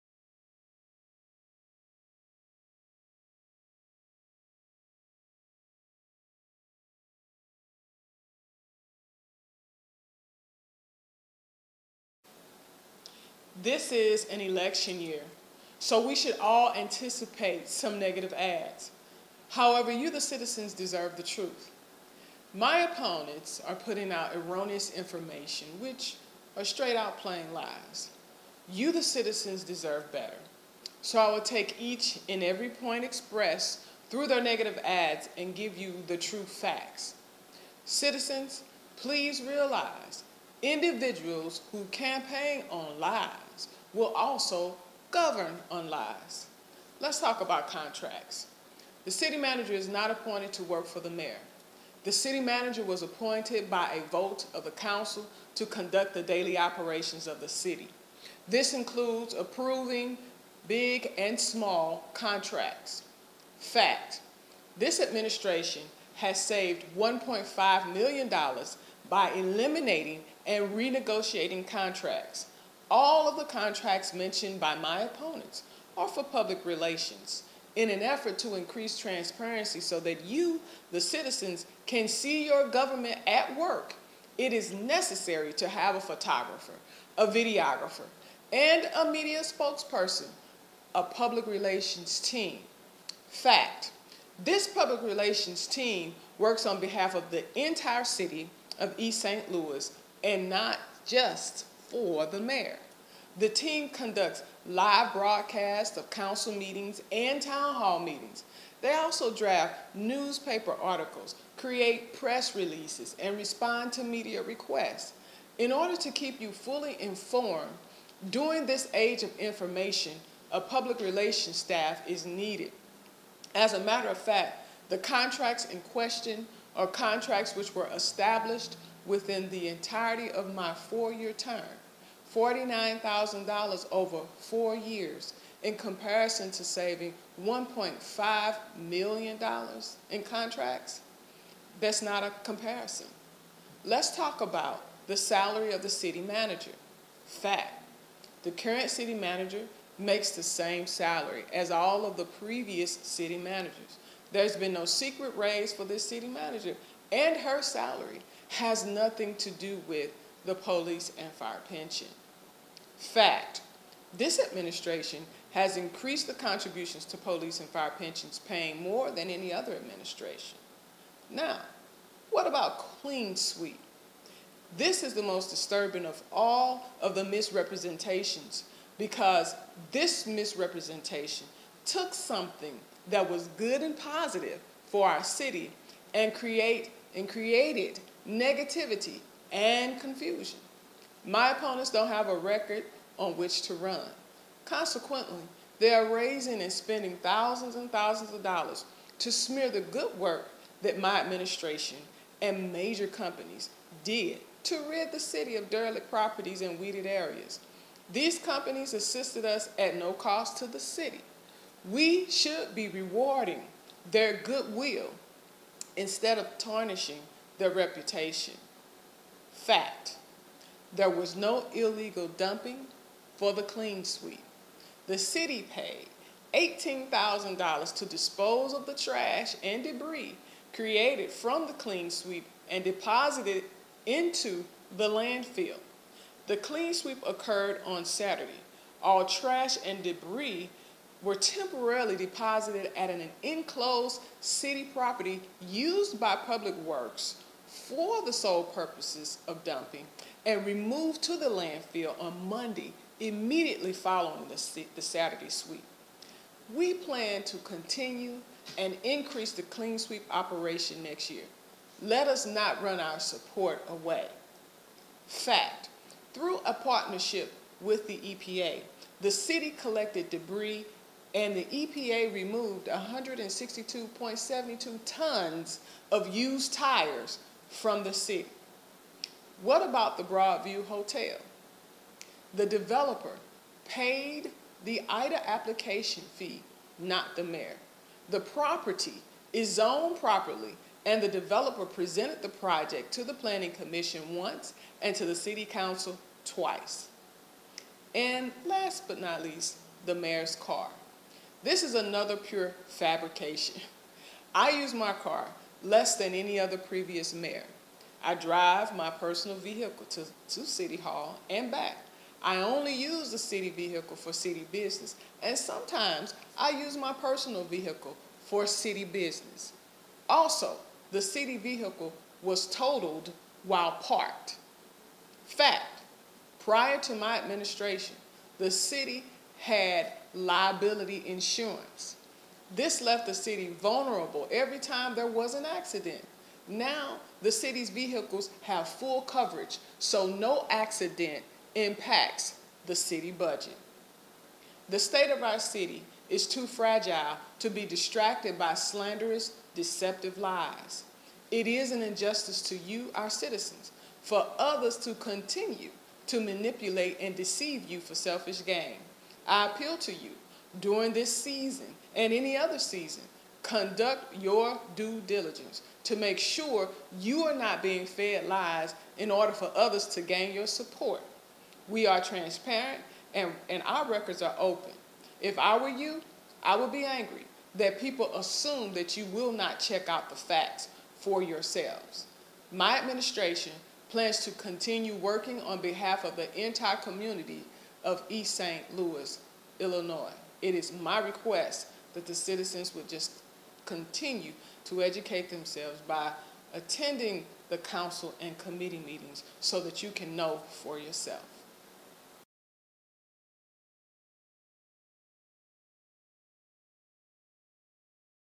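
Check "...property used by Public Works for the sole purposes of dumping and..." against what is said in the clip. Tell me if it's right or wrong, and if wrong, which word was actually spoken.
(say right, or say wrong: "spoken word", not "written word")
right.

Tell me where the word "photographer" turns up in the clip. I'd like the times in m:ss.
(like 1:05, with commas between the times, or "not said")
1:26.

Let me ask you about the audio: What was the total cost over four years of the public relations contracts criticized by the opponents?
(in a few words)
$49,000.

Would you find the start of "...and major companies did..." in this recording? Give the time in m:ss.
3:22.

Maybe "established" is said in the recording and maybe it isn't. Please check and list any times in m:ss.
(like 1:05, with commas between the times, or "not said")
2:07.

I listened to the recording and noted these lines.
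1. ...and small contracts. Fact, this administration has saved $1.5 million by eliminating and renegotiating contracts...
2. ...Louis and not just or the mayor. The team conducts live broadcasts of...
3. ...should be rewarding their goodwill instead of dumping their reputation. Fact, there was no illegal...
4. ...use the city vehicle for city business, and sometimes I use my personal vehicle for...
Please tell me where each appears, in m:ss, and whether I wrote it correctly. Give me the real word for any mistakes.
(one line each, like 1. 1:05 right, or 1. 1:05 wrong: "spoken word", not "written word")
1. 1:01 right
2. 1:39 right
3. 3:32 wrong: "tarnishing", not "dumping"
4. 5:12 right.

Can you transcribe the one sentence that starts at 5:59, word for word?
I appeal to you during this season and any other season.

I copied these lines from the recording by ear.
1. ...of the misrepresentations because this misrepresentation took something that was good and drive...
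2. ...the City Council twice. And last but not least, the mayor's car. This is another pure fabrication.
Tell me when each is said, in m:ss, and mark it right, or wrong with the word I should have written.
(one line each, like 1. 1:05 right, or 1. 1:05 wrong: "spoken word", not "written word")
1. 2:57 wrong: "positive", not "drive"
2. 4:55 right.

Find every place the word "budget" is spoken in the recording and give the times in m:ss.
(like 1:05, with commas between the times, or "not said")
5:43.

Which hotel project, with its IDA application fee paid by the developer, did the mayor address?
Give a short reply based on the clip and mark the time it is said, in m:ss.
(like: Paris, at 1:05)
Broadview Hotel, at 4:40.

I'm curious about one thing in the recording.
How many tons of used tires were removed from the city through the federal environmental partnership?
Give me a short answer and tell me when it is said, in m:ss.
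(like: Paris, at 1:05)
162.72, at 4:32.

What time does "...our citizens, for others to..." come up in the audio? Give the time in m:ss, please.
5:53.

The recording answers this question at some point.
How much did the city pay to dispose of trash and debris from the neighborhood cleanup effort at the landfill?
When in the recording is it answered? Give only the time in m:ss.
3:46.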